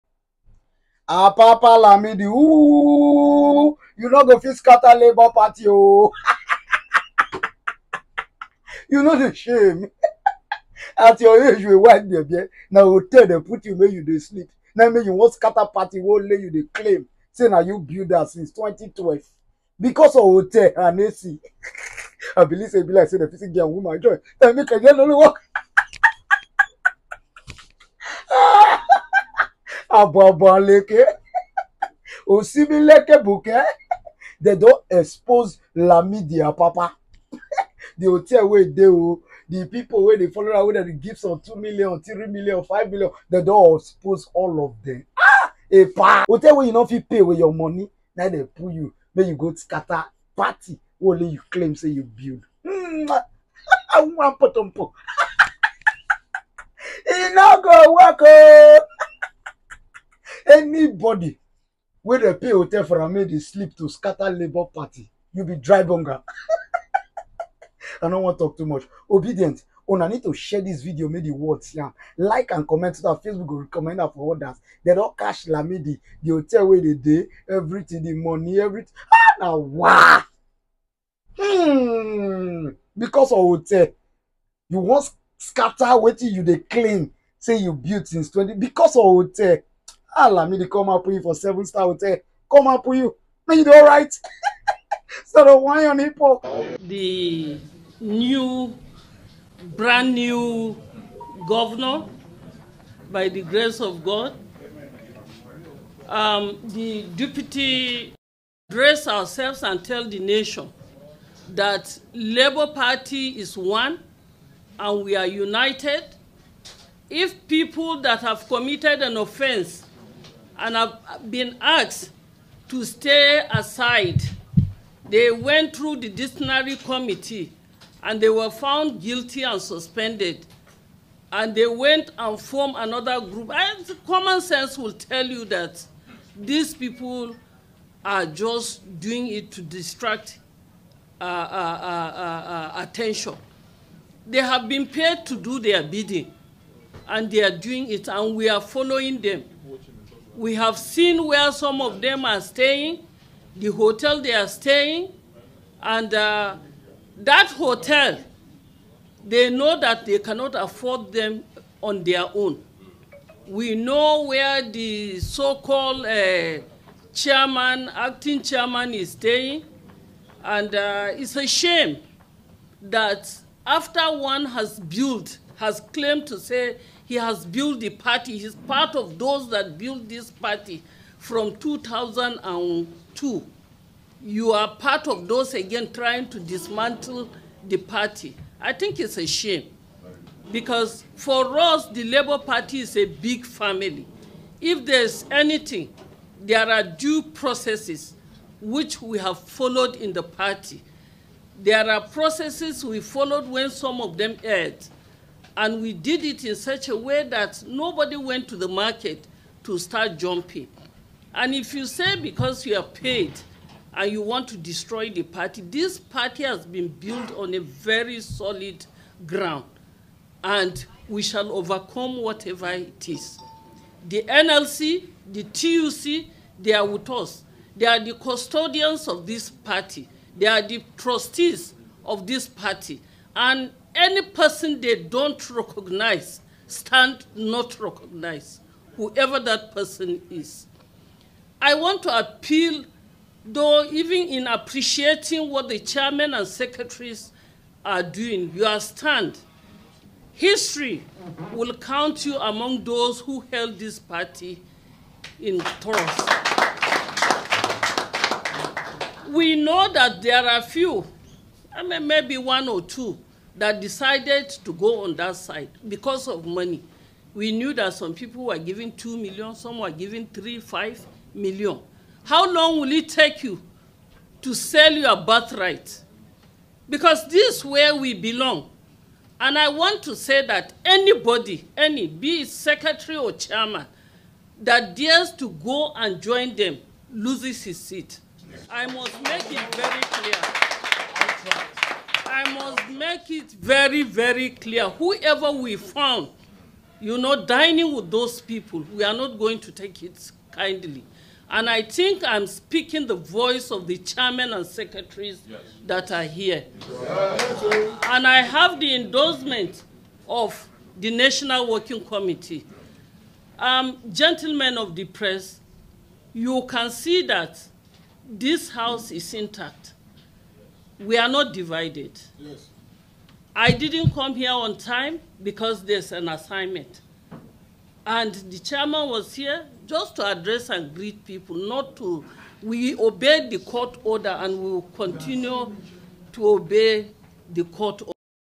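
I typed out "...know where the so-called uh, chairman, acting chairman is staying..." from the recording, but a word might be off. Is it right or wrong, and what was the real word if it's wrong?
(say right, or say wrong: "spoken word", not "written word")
right.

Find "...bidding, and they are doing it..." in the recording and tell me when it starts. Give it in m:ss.
2:25.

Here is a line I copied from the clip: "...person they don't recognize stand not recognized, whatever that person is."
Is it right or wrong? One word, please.
wrong.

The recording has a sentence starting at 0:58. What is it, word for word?
Oh anybody wey dey pay hotel for am make dey sleep to scatter labour party you be dry bunga.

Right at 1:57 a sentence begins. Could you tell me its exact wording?
If people that have committed an offense and have been asked to stay aside.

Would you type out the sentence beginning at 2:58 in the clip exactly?
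He's part of those that built this party from 2002.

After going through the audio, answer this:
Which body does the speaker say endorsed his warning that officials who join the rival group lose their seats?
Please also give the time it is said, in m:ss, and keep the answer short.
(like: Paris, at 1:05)
National Working Committee, at 5:11.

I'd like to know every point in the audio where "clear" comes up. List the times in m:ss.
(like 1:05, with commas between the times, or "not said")
4:50, 4:54.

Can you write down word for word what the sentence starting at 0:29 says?
àbọ̀bọ̀ lèkè òsínmi lẹ́kẹ̀ they don expose media, Papa.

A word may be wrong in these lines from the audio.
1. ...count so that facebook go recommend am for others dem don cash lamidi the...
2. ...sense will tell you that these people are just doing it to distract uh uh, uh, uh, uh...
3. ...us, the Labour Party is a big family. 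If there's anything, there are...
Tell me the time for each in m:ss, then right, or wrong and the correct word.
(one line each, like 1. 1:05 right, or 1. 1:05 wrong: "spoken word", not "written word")
1. 1:12 wrong: "comment", not "count"
2. 2:14 right
3. 3:11 right.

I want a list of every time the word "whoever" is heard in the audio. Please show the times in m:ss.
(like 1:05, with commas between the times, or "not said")
3:58, 4:54.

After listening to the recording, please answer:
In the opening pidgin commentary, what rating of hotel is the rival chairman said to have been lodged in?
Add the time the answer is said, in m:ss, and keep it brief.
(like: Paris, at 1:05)
seven star, at 1:31.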